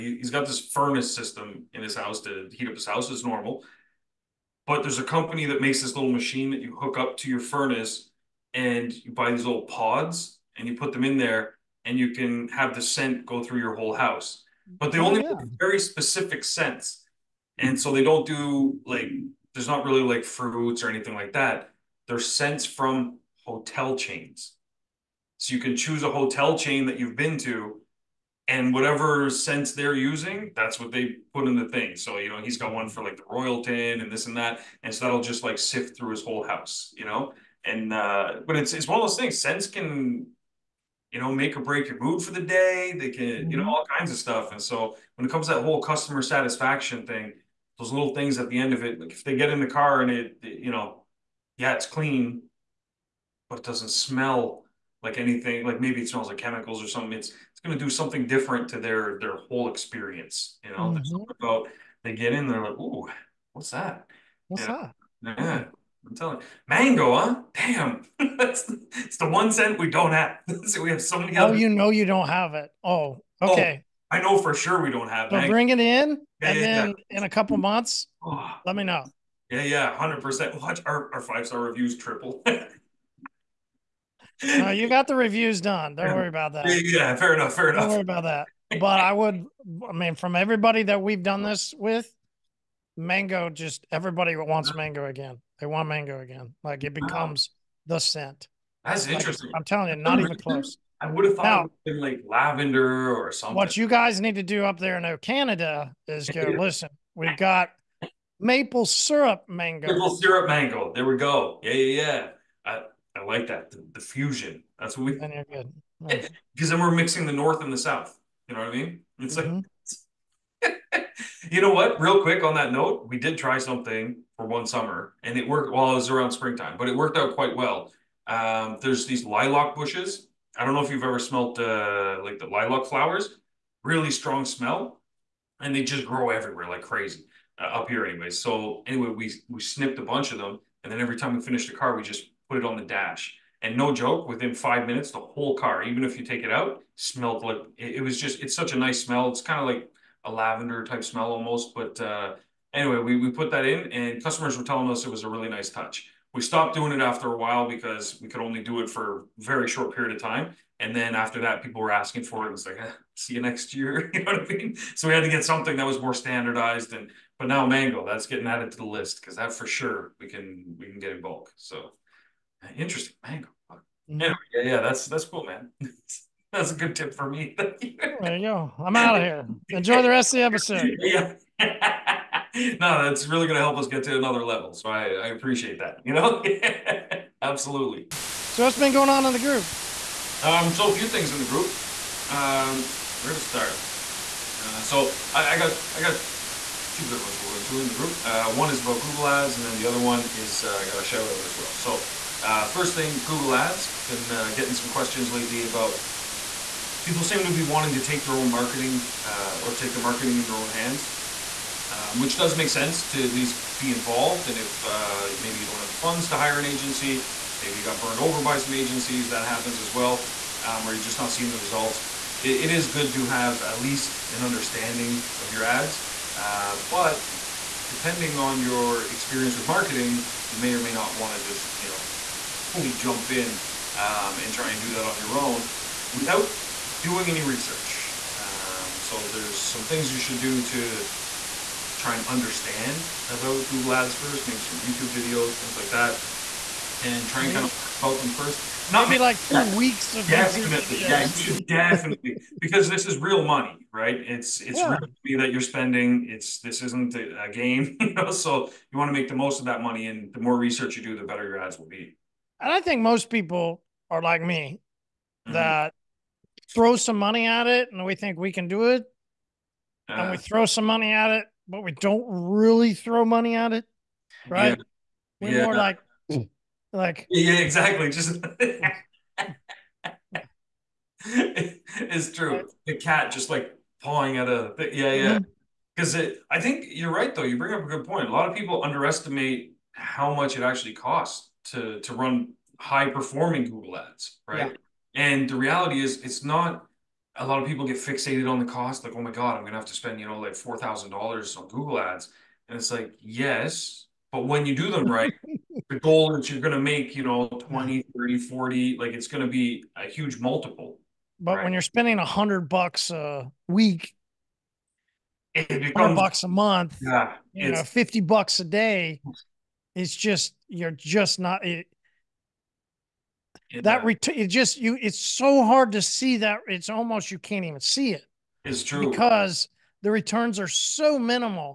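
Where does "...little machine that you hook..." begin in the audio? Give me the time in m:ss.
0:05.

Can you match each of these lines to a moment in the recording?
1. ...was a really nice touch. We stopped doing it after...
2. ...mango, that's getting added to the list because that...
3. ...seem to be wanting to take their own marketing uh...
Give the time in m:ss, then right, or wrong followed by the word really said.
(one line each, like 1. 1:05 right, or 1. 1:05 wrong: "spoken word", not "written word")
1. 2:35 right
2. 2:47 right
3. 3:27 right.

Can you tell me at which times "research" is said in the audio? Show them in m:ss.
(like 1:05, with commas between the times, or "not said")
3:57, 4:20.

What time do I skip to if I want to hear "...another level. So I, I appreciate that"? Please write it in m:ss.
3:04.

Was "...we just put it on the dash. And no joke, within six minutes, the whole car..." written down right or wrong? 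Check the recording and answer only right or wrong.
wrong.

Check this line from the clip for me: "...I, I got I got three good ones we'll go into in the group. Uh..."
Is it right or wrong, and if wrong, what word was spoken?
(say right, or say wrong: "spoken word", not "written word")
wrong: "two", not "three".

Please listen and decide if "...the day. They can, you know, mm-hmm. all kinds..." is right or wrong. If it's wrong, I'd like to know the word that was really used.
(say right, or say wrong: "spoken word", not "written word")
right.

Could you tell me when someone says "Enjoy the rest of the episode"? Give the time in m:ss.
2:59.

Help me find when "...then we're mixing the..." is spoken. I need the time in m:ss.
1:56.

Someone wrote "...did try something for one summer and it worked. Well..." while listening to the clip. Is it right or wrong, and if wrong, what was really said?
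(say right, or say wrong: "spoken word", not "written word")
right.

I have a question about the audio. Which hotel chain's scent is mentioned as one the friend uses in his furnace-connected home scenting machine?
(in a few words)
Royalton.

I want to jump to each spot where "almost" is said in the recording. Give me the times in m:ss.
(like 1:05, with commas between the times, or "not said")
2:31, 5:26.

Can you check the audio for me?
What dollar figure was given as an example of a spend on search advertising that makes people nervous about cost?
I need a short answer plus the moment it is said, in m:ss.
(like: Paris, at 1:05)
$4,000, at 5:00.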